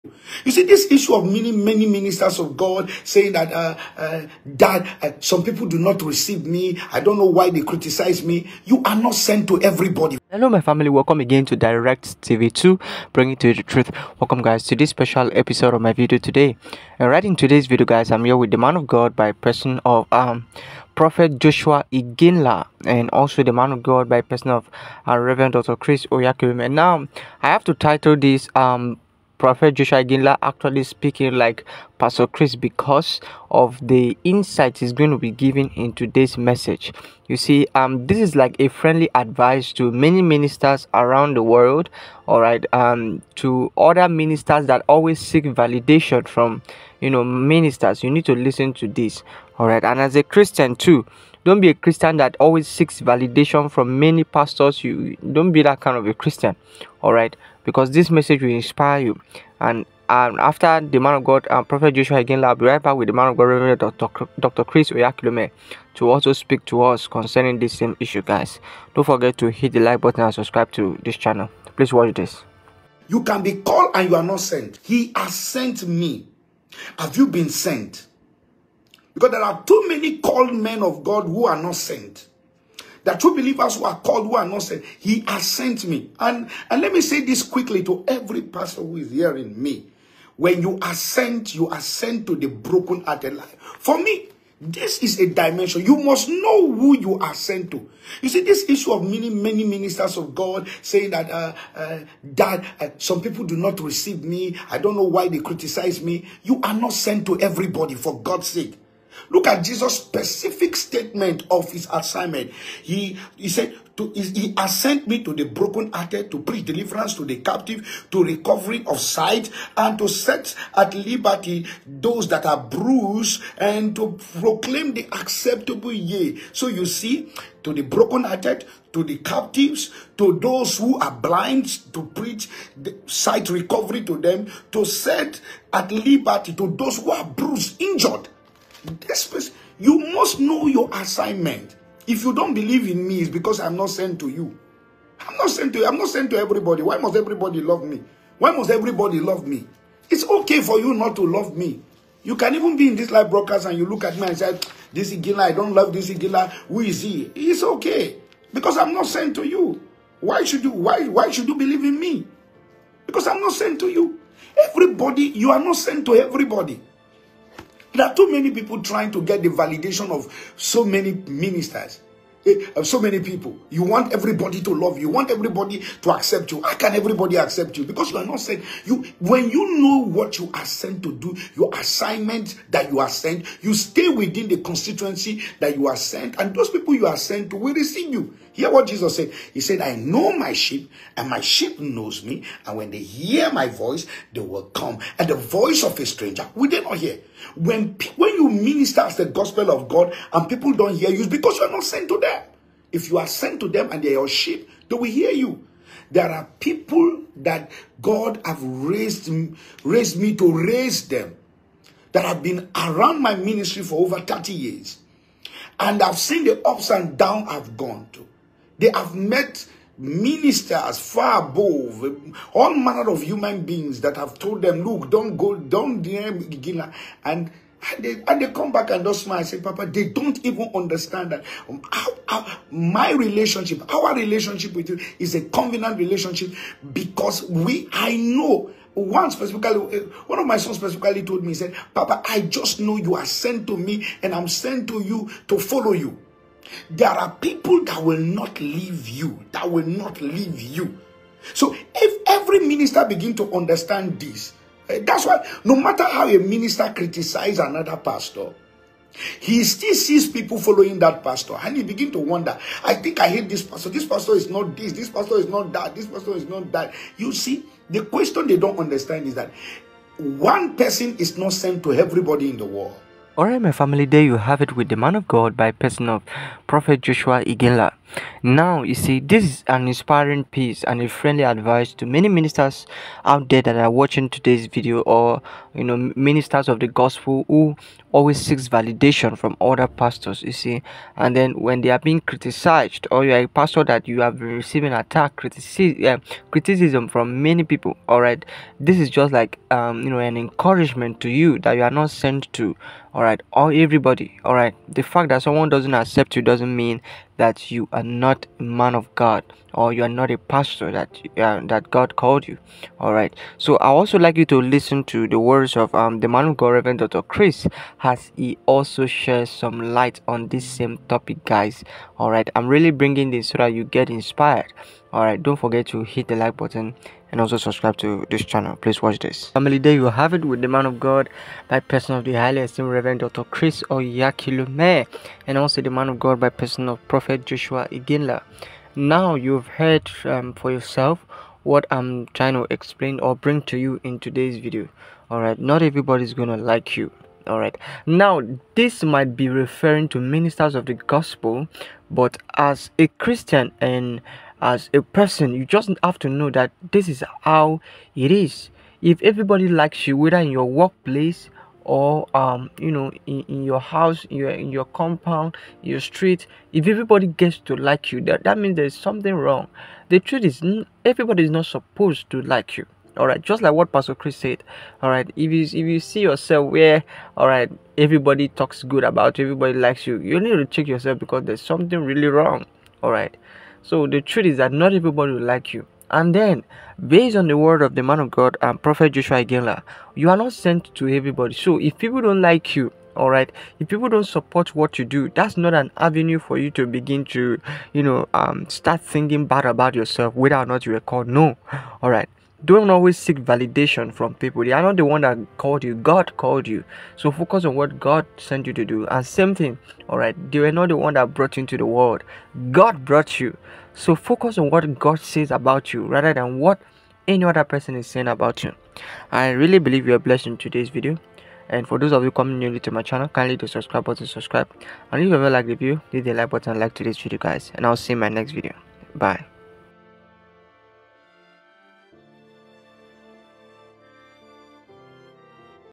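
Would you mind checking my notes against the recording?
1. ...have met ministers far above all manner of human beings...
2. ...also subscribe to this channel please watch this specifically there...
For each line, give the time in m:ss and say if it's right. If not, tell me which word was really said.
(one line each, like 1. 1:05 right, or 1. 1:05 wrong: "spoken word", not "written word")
1. 3:38 right
2. 5:27 wrong: "family", not "specifically".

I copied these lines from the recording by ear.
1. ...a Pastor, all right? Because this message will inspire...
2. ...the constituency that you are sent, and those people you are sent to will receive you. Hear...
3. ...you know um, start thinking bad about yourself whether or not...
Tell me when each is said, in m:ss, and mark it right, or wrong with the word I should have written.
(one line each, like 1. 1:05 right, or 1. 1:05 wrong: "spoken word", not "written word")
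1. 0:56 wrong: "Christian", not "Pastor"
2. 3:04 right
3. 6:37 right.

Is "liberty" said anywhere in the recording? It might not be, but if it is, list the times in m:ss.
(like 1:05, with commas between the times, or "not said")
2:00, 2:15.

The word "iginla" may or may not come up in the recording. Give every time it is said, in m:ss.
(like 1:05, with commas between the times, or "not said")
0:21, 0:30, 1:02, 4:37, 5:37, 6:29.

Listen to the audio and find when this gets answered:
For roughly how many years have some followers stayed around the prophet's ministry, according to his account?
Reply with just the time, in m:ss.
3:34.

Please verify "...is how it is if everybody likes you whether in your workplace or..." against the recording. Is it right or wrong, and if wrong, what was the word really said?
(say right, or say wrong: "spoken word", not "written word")
right.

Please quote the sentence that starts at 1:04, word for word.
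Chris Oyakhilome, to also speak to us concerning this same issue, guys.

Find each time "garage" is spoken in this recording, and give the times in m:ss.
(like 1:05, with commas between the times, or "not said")
not said.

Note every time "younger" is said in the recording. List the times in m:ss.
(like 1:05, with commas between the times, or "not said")
not said.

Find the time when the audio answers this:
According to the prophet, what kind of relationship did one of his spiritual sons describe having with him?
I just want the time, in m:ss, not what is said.
3:55.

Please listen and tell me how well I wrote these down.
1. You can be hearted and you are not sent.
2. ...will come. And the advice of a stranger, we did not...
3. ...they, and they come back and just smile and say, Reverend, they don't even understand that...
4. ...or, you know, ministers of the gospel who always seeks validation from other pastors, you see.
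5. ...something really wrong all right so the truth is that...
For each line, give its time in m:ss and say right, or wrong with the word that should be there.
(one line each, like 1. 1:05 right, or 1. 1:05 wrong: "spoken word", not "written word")
1. 1:13 wrong: "called", not "hearted"
2. 3:14 wrong: "voice", not "advice"
3. 3:47 wrong: "Papa", not "Reverend"
4. 4:45 right
5. 6:21 right.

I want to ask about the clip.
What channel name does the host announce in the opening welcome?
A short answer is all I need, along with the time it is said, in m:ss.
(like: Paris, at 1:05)
Direct TV 2, at 0:11.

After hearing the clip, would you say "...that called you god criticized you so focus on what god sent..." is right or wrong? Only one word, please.
wrong.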